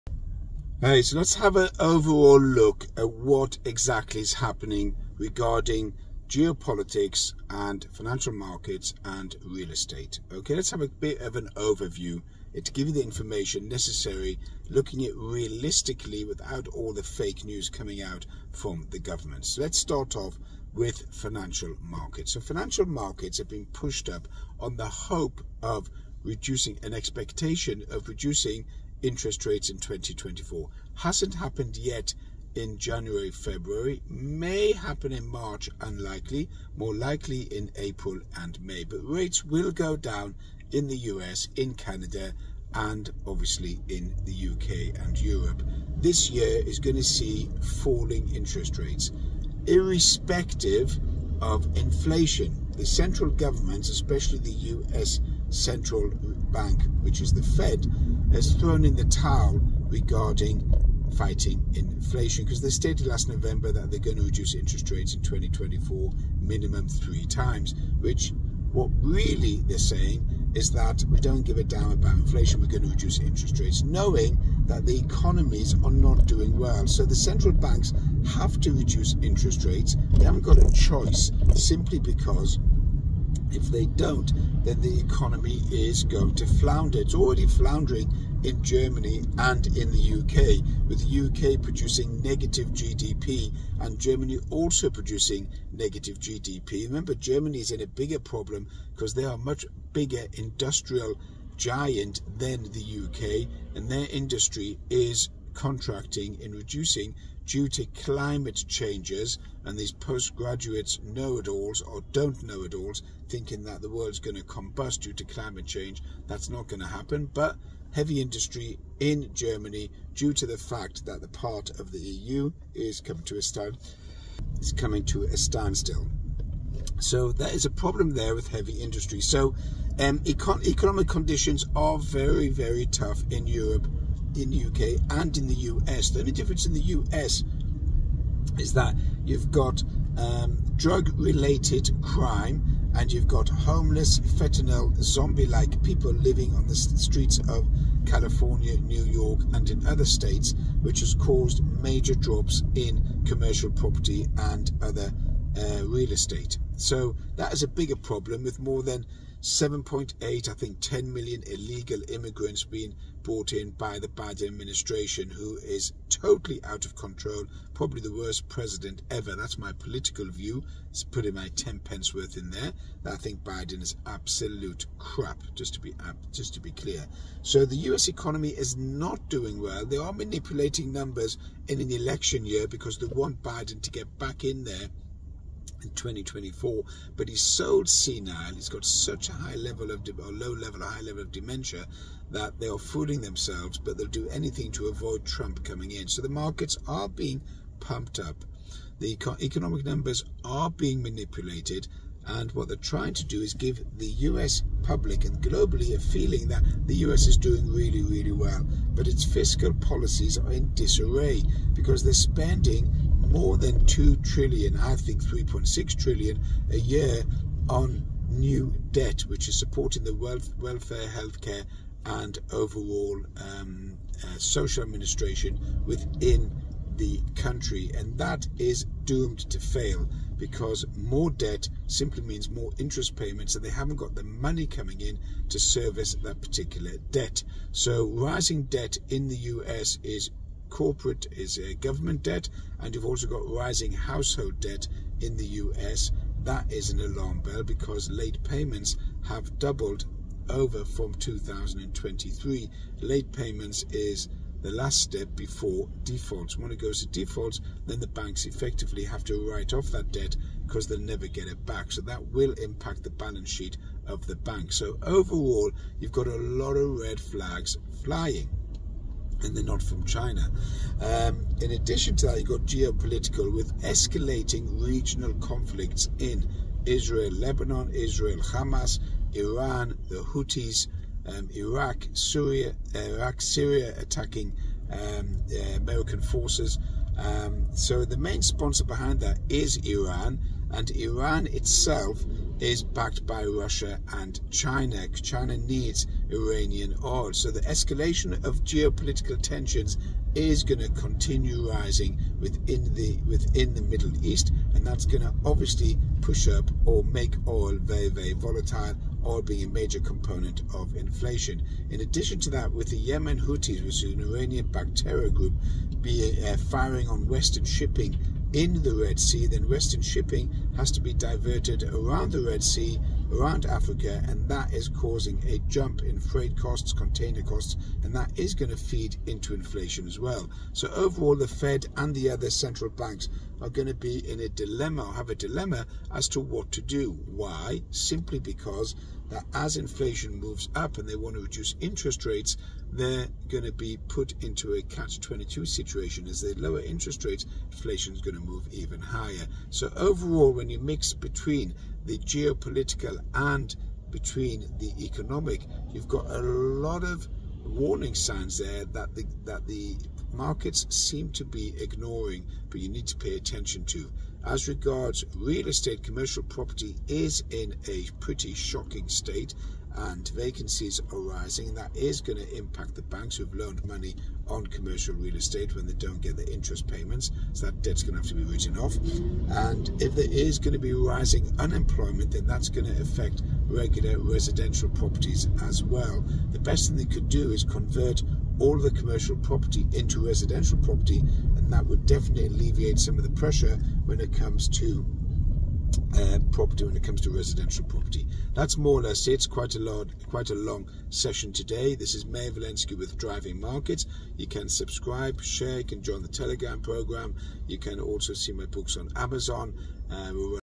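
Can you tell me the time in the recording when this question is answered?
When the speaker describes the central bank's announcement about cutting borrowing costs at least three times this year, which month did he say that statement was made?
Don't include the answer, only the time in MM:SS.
01:03.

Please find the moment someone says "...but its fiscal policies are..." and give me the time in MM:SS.
03:28.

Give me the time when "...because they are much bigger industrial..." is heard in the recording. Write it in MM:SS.
01:38.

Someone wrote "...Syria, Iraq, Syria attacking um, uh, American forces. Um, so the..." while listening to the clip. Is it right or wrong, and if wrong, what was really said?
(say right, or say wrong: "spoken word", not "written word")
right.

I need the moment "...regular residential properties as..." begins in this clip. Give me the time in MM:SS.
06:23.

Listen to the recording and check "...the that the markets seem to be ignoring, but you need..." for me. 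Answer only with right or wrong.
right.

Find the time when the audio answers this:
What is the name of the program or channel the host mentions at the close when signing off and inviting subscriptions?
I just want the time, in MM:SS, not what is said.
06:43.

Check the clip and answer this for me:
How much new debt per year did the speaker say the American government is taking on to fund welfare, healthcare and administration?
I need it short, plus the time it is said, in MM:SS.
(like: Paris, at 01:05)
3.6 trillion, at 03:35.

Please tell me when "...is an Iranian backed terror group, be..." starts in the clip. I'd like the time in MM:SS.
05:14.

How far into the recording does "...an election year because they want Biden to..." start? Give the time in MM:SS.
03:01.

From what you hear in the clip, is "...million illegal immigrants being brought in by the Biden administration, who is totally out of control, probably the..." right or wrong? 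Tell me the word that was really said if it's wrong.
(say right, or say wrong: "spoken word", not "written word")
right.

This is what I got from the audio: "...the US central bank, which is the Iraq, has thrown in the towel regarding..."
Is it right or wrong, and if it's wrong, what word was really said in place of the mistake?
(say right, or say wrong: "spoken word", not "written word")
wrong: "Fed", not "Iraq".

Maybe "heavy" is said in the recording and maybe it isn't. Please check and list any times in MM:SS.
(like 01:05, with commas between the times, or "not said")
01:57, 02:08.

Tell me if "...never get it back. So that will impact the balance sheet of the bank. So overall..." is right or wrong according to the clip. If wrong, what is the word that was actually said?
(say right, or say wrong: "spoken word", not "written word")
right.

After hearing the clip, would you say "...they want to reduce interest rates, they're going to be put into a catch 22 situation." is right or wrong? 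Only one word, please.
right.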